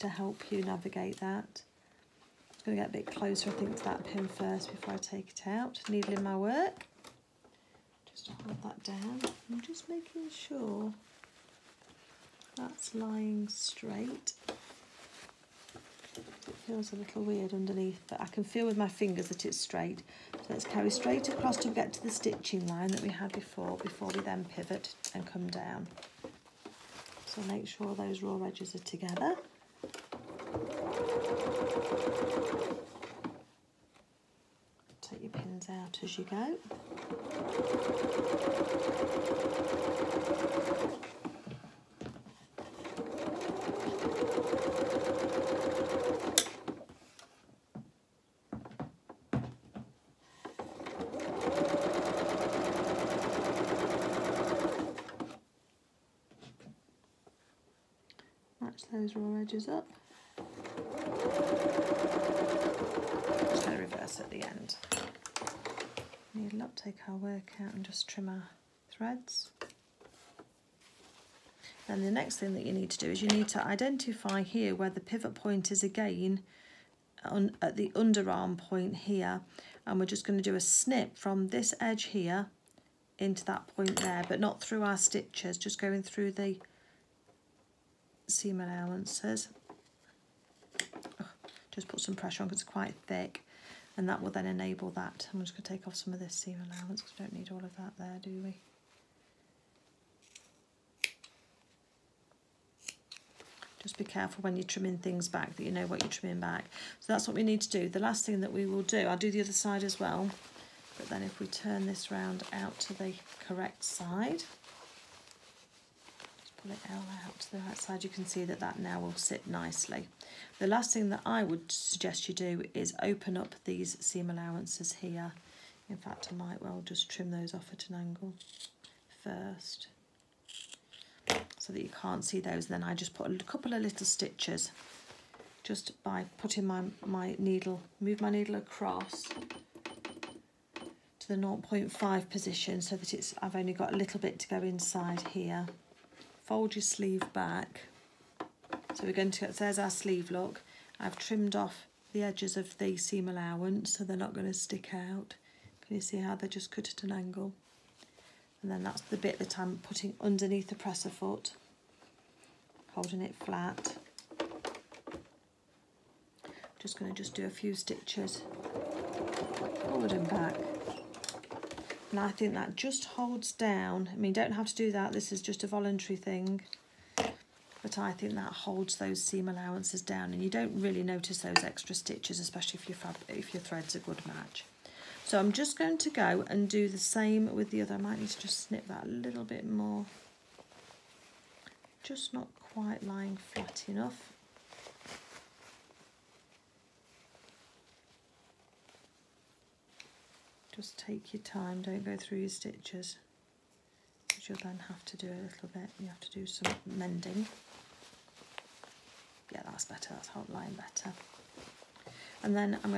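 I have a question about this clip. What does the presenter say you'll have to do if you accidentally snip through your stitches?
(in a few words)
mending.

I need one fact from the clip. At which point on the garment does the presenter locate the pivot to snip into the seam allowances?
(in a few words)
underarm point.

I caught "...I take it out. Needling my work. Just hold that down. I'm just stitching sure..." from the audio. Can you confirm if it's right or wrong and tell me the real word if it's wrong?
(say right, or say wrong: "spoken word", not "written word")
wrong: "making", not "stitching".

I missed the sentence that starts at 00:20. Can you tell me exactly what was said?
So let's carry straight across to get to the stitching line that we had before, before we then pivot and come down.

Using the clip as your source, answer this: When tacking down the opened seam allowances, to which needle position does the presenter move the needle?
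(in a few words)
0.5.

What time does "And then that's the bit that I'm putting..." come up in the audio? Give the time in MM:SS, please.
02:38.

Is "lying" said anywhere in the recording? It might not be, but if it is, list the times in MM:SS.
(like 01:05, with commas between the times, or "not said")
00:12, 03:13.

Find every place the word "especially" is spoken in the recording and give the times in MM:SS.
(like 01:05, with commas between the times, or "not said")
03:02.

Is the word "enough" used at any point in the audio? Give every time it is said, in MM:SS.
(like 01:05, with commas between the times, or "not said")
03:13.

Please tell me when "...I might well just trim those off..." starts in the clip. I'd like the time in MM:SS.
02:06.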